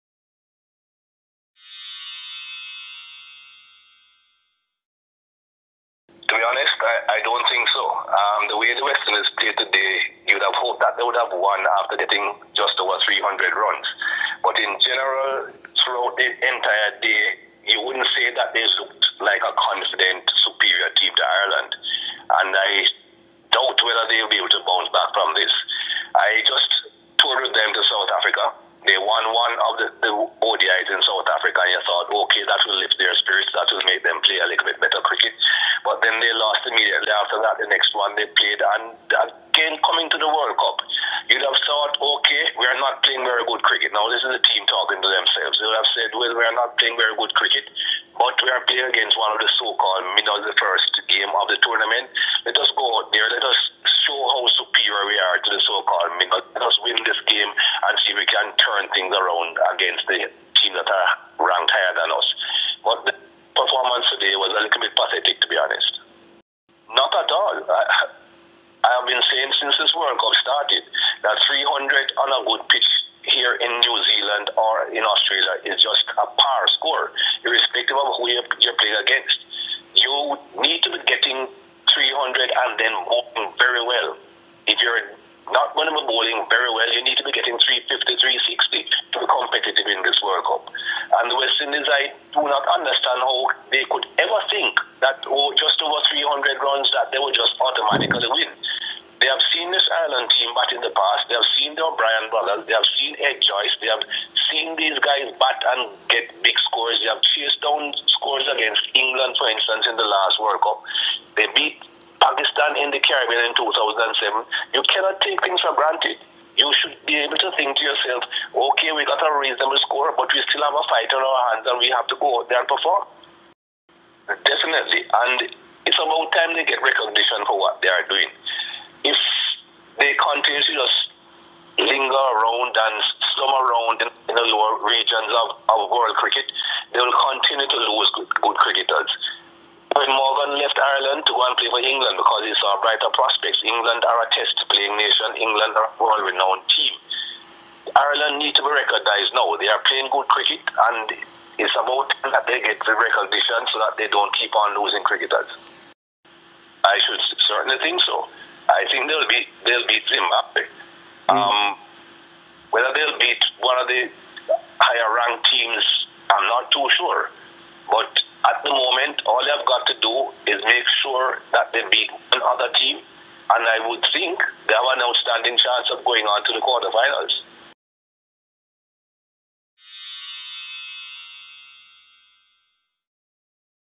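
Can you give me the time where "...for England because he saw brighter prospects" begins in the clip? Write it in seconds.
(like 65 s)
141 s.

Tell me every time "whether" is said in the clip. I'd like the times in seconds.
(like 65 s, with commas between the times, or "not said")
23 s, 162 s.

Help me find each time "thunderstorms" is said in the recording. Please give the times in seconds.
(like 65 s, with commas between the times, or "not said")
not said.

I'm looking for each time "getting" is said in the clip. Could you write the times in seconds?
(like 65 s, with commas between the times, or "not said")
11 s, 81 s, 87 s.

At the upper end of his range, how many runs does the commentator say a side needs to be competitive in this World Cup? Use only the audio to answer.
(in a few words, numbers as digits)
360.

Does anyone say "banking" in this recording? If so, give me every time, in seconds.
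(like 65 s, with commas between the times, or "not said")
not said.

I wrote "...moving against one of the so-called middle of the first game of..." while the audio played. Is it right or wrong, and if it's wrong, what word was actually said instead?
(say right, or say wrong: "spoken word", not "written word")
wrong: "playing", not "moving".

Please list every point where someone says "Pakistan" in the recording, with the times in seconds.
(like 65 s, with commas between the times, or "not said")
112 s.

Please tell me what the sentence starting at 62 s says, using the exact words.
But the performance today was a little bit pathetic, to be honest.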